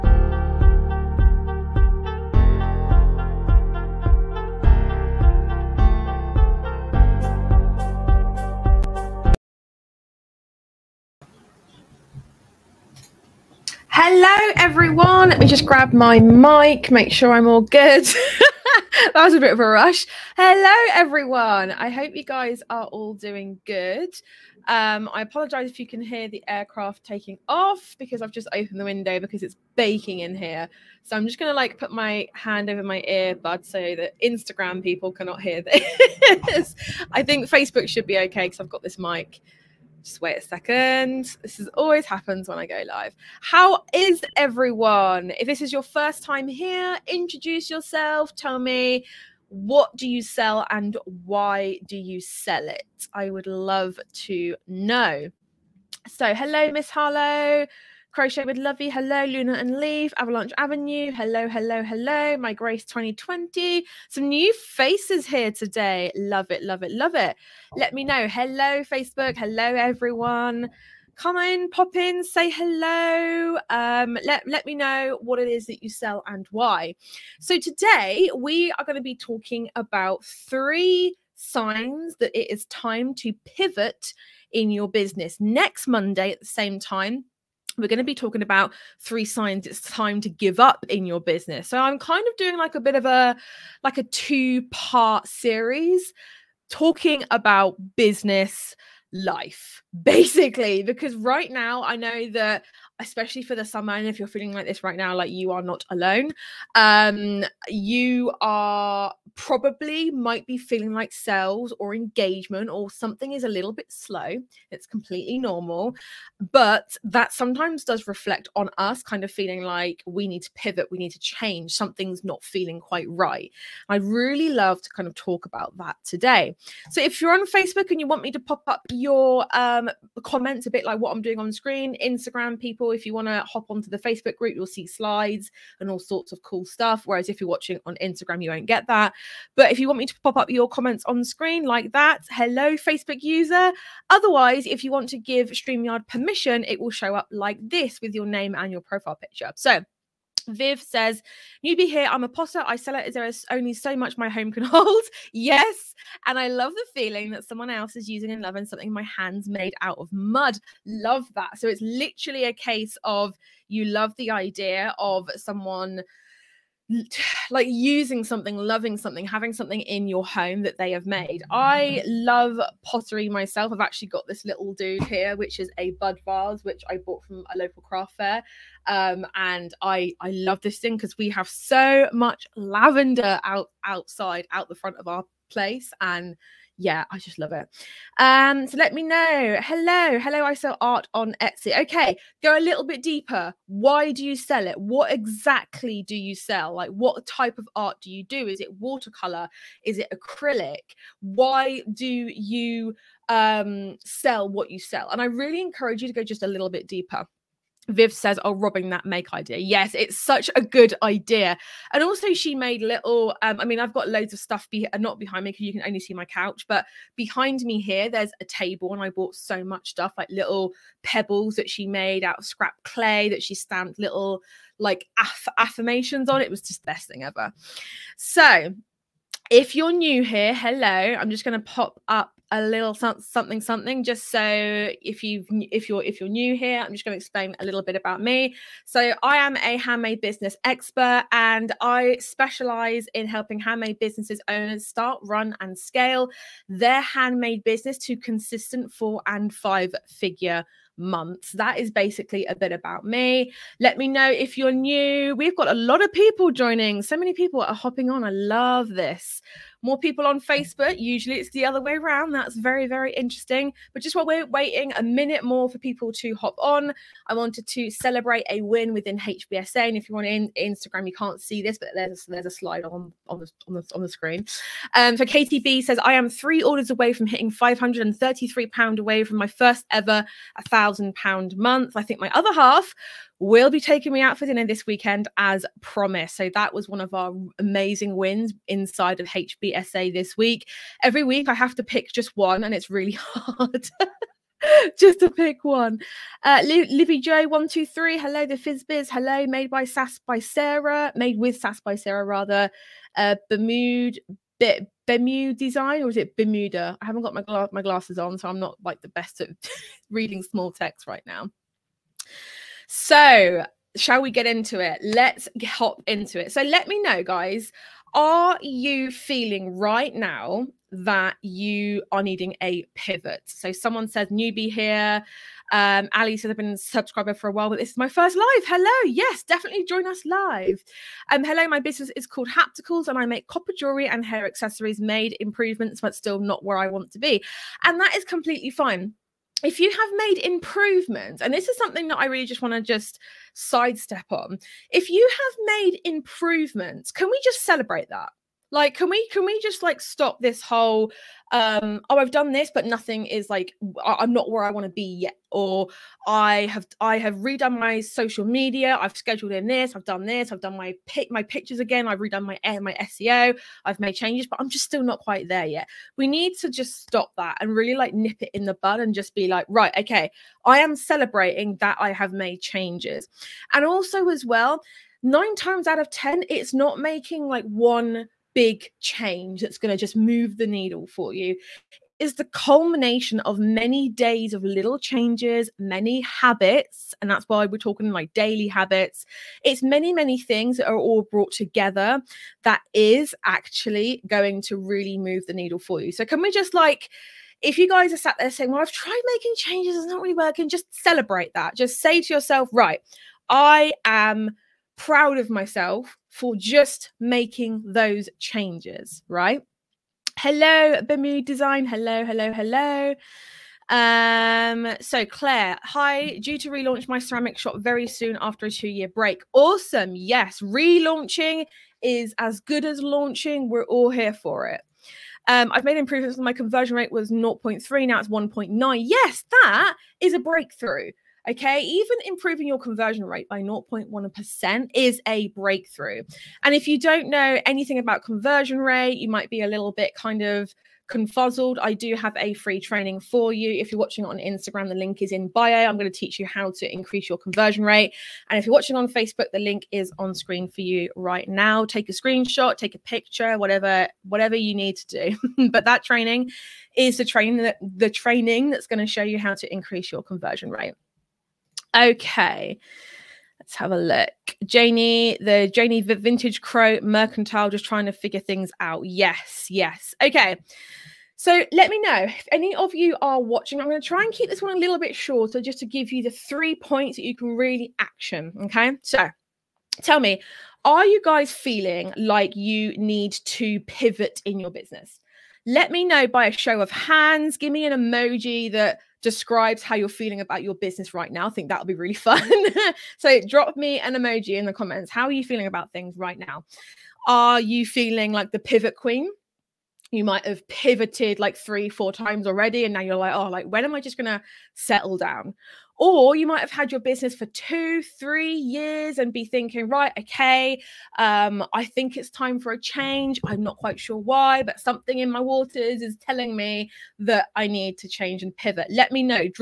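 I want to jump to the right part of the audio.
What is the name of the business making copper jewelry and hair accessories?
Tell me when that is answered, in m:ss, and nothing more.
5:32.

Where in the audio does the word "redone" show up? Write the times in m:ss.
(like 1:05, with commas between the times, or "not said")
5:57, 6:02.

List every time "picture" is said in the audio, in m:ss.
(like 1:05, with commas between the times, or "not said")
2:29, 6:01, 7:32.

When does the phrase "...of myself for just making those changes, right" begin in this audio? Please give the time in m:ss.
6:45.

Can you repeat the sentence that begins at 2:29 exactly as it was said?
So Viv says, newbie here, I'm a potter.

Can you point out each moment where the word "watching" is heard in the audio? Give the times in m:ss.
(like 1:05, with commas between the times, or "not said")
2:17, 7:23, 7:28, 7:53.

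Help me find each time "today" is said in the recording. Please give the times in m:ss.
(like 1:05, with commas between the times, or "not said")
1:05, 1:17, 2:06.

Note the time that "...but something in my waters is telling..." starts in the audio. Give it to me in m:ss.
8:34.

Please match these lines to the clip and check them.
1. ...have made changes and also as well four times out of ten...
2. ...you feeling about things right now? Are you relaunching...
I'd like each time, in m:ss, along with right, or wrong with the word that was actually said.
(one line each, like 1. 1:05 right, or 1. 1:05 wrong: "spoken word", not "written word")
1. 6:12 wrong: "nine", not "four"
2. 8:15 wrong: "feeling", not "relaunching".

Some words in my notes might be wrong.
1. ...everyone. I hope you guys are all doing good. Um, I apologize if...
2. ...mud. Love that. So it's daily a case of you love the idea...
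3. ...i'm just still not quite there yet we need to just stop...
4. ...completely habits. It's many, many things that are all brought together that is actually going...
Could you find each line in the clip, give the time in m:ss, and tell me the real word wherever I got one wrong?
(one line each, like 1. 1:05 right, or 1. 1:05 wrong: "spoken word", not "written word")
1. 0:20 right
2. 2:40 wrong: "literally", not "daily"
3. 6:04 right
4. 6:28 wrong: "daily", not "completely".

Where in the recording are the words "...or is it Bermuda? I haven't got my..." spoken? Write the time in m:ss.
5:06.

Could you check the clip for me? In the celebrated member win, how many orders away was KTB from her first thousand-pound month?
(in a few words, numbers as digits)
3.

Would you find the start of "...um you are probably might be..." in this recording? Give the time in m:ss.
1:46.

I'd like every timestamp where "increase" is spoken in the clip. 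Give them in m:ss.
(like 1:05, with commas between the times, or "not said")
7:26, 7:39.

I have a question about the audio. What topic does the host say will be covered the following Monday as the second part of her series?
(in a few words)
Three signs it's time to give up.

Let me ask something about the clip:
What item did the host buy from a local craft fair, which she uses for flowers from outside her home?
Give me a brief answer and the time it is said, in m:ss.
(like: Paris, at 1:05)
Bud vase, at 2:55.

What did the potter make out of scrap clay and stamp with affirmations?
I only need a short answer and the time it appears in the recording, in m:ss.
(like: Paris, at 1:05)
Pebbles, at 3:40.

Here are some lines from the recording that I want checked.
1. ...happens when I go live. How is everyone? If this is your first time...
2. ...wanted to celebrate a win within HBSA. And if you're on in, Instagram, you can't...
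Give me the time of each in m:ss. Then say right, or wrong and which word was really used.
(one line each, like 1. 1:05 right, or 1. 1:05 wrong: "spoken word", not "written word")
1. 0:42 right
2. 4:27 right.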